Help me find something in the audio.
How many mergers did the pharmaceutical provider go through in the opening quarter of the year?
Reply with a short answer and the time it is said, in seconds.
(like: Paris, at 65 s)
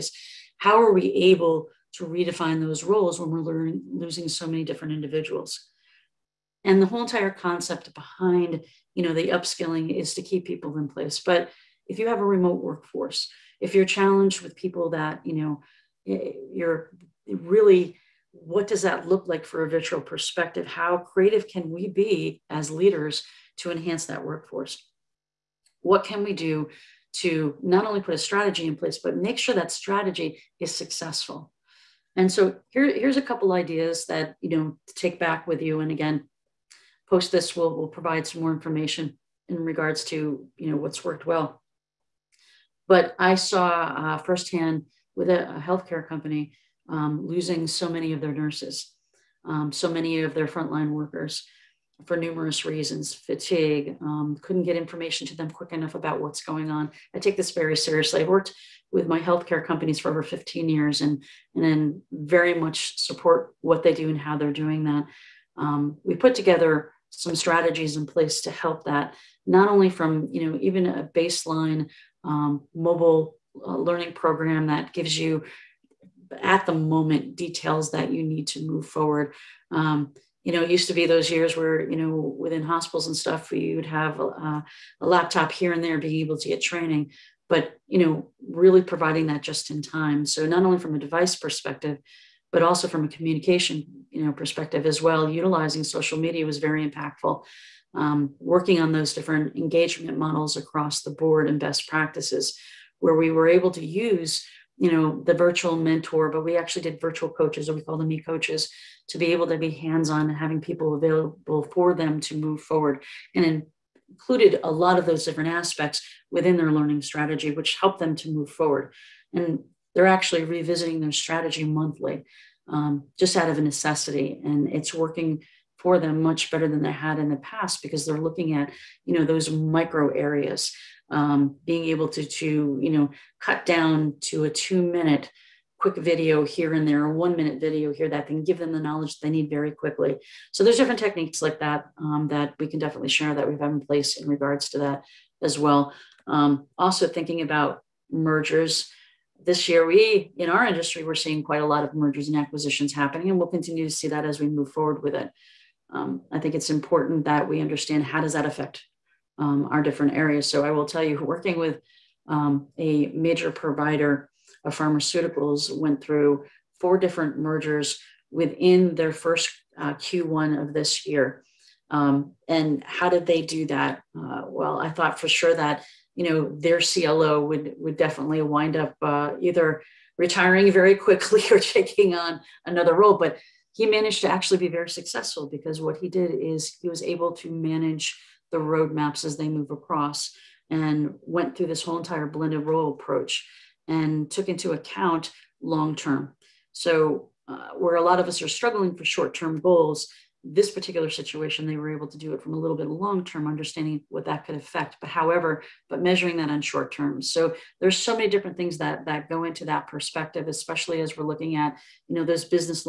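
4, at 166 s.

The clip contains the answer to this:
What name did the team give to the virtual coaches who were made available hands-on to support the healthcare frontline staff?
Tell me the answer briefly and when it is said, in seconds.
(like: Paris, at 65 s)
e-coaches, at 108 s.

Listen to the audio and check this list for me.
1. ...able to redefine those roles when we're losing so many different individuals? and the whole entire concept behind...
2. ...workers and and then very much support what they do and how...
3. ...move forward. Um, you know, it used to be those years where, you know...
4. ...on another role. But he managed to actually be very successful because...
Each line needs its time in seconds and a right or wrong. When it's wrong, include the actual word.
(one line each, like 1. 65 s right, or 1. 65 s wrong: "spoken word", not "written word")
1. 1 s right
2. 60 s wrong: "years", not "workers"
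3. 78 s right
4. 182 s right.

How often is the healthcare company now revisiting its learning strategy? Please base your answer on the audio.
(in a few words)
Monthly.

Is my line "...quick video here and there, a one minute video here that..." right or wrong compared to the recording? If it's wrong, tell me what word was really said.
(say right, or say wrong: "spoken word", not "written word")
right.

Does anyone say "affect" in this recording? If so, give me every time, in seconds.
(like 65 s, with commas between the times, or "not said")
158 s, 204 s.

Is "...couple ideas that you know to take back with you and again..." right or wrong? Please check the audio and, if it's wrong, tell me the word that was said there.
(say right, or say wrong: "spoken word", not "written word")
right.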